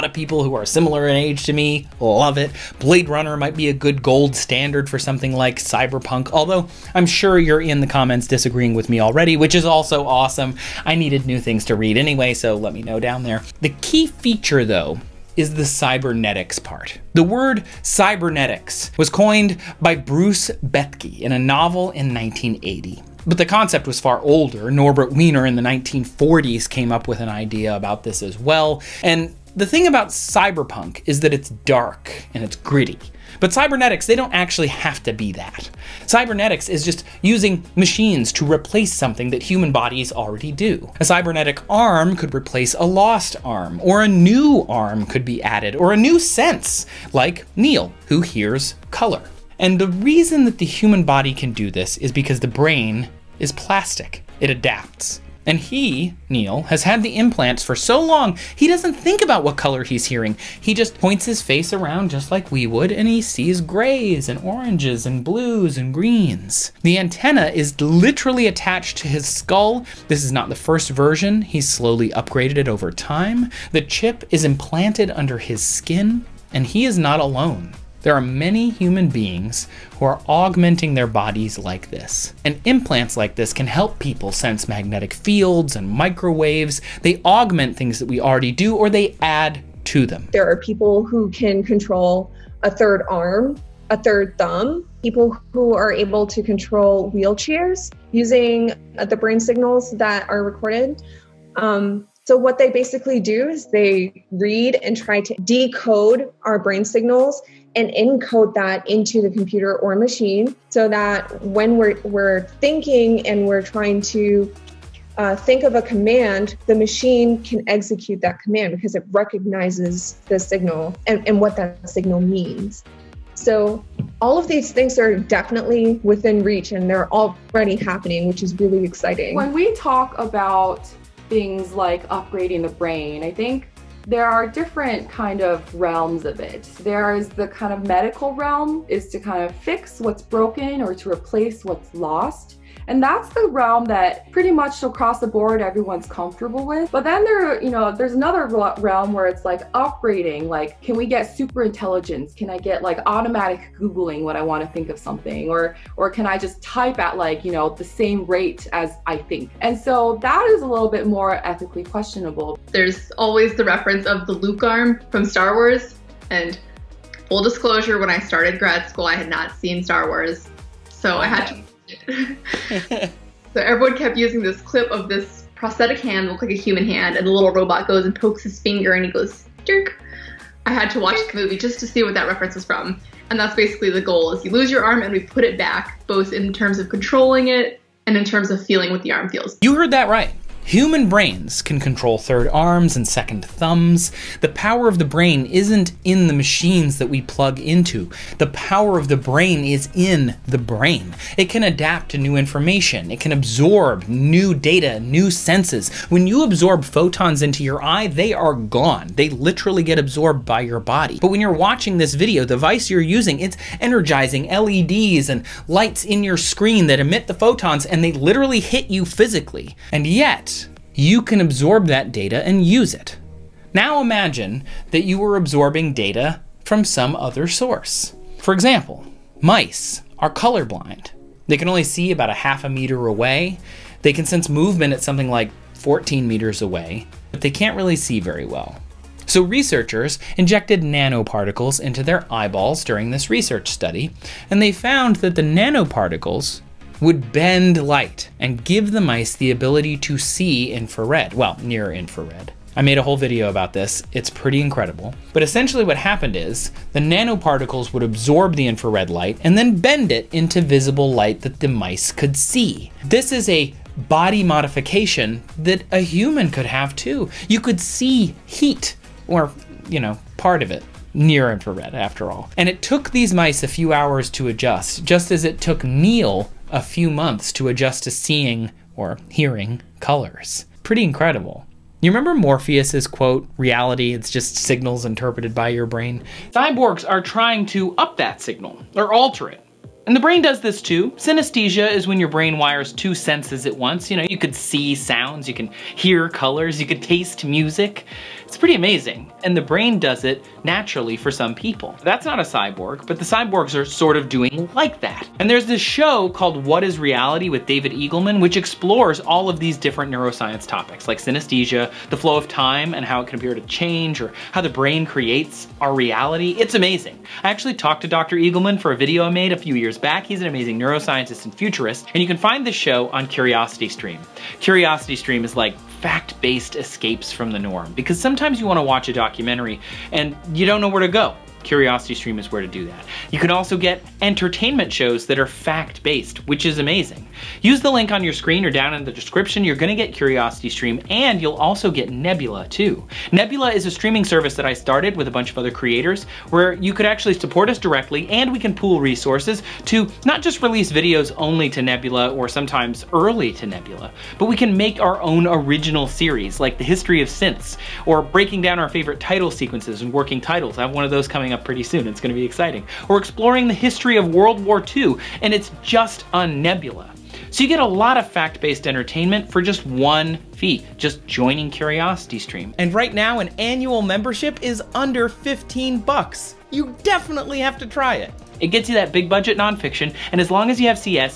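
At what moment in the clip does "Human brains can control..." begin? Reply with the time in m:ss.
3:10.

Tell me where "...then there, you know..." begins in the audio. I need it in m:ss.
2:27.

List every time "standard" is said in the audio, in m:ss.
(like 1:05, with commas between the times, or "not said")
0:04.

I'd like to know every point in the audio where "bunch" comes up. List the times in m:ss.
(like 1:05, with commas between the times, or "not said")
5:45.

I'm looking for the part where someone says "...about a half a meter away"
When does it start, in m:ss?
3:52.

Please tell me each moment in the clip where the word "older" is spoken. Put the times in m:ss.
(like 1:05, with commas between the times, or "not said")
0:24.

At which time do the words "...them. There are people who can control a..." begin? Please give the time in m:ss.
1:30.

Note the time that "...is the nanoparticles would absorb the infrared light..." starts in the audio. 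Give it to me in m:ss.
4:16.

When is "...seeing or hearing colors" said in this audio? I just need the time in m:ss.
4:38.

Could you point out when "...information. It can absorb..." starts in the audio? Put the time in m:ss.
3:22.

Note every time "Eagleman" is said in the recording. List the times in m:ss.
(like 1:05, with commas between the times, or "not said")
5:07, 5:18.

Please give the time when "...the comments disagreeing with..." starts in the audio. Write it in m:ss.
0:07.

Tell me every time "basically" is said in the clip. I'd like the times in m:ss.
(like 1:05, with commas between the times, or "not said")
1:42, 3:03.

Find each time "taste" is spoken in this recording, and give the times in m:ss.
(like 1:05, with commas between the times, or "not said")
4:57.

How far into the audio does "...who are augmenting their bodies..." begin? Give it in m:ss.
1:19.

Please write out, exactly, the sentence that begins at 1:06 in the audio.
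The antenna is literally attached to his skull.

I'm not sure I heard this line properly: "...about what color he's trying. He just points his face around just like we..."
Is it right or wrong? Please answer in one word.
wrong.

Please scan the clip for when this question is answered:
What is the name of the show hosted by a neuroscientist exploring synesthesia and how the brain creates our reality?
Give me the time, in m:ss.
5:06.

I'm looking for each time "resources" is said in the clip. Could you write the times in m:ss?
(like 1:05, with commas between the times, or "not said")
5:48.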